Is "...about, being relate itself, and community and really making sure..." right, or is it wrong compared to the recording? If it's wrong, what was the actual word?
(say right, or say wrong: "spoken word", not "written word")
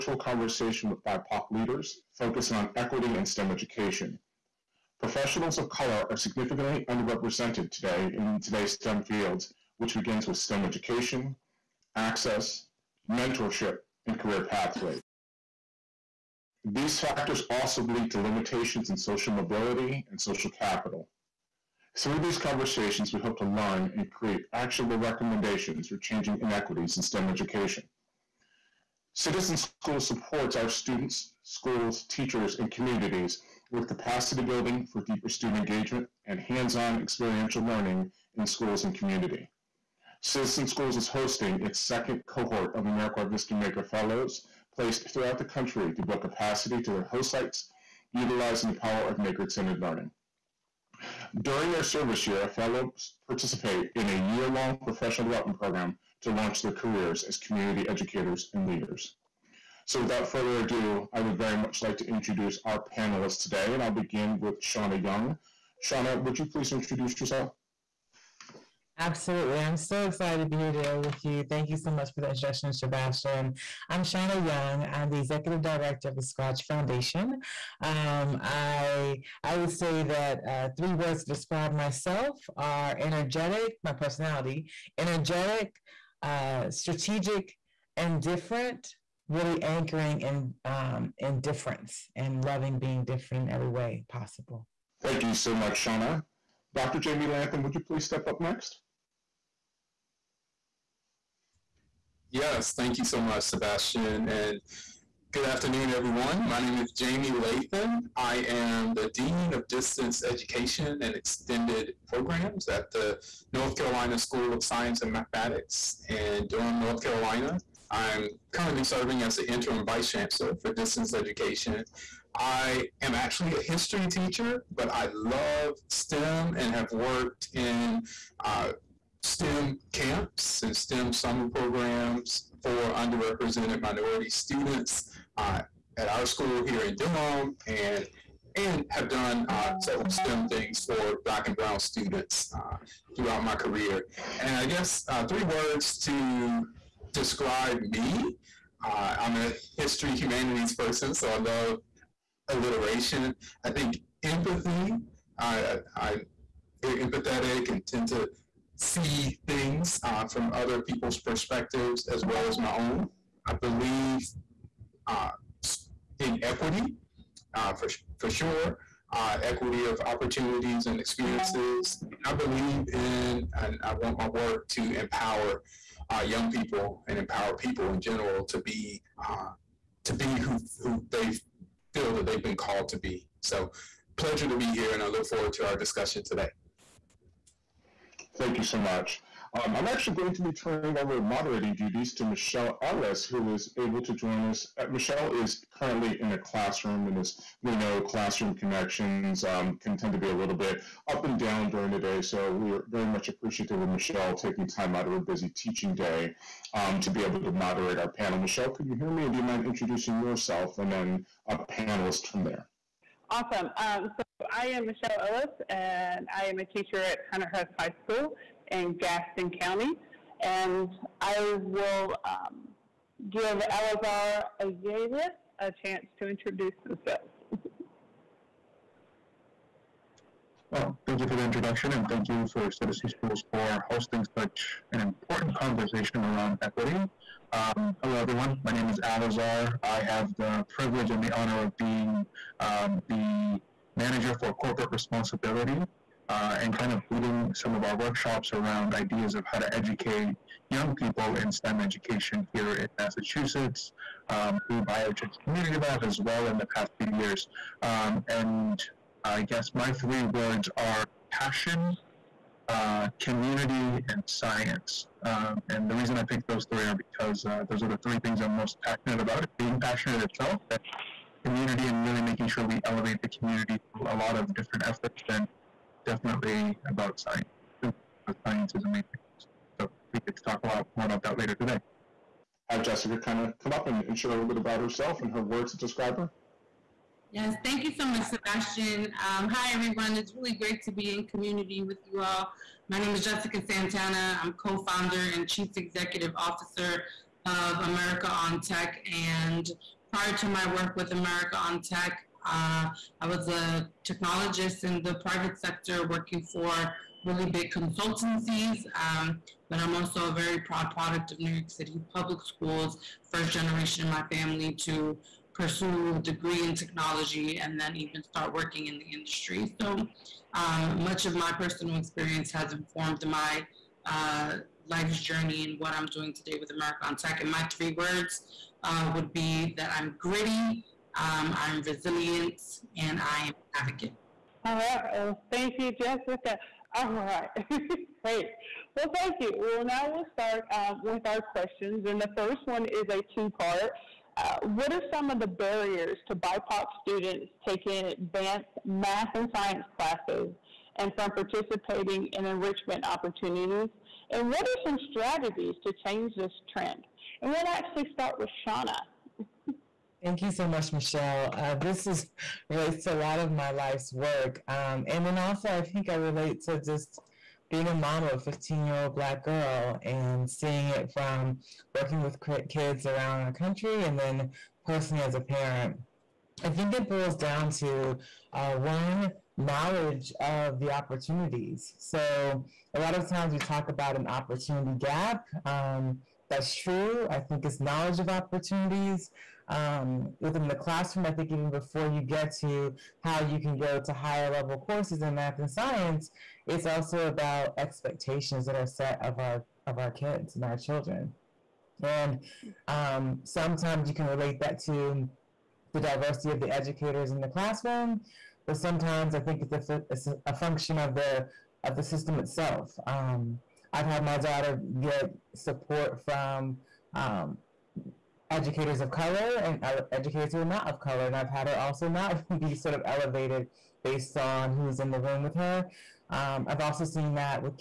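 wrong: "passionate", not "relate".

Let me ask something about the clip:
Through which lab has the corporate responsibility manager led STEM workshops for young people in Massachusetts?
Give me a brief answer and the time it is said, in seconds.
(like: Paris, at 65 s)
BioTech Community Lab, at 254 s.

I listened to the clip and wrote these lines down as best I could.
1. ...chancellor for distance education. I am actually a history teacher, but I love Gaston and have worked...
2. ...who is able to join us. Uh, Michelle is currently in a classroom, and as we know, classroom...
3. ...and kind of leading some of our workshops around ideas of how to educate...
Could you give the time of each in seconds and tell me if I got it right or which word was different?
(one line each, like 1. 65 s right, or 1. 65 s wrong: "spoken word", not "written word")
1. 120 s wrong: "STEM", not "Gaston"
2. 193 s right
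3. 246 s right.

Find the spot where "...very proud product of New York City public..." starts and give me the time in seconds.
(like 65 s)
310 s.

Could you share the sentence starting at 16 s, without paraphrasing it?
These factors also lead to limitations in social mobility and social capital.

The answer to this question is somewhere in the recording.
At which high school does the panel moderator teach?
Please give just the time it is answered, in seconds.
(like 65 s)
217 s.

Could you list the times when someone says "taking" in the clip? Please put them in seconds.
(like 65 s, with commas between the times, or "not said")
204 s, 347 s.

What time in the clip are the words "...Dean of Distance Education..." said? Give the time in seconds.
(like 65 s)
109 s.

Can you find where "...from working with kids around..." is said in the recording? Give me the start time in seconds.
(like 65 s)
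371 s.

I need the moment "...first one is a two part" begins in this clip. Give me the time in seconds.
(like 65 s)
342 s.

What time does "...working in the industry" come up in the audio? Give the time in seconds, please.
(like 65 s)
318 s.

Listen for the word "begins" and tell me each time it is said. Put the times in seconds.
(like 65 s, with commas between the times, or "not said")
9 s, 63 s.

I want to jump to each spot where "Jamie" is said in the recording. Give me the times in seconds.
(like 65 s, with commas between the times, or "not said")
97 s, 106 s.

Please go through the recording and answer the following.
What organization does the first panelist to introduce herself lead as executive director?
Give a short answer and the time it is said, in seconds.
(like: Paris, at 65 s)
Scratch Foundation, at 76 s.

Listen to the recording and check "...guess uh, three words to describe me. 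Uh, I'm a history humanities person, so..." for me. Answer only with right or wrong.
right.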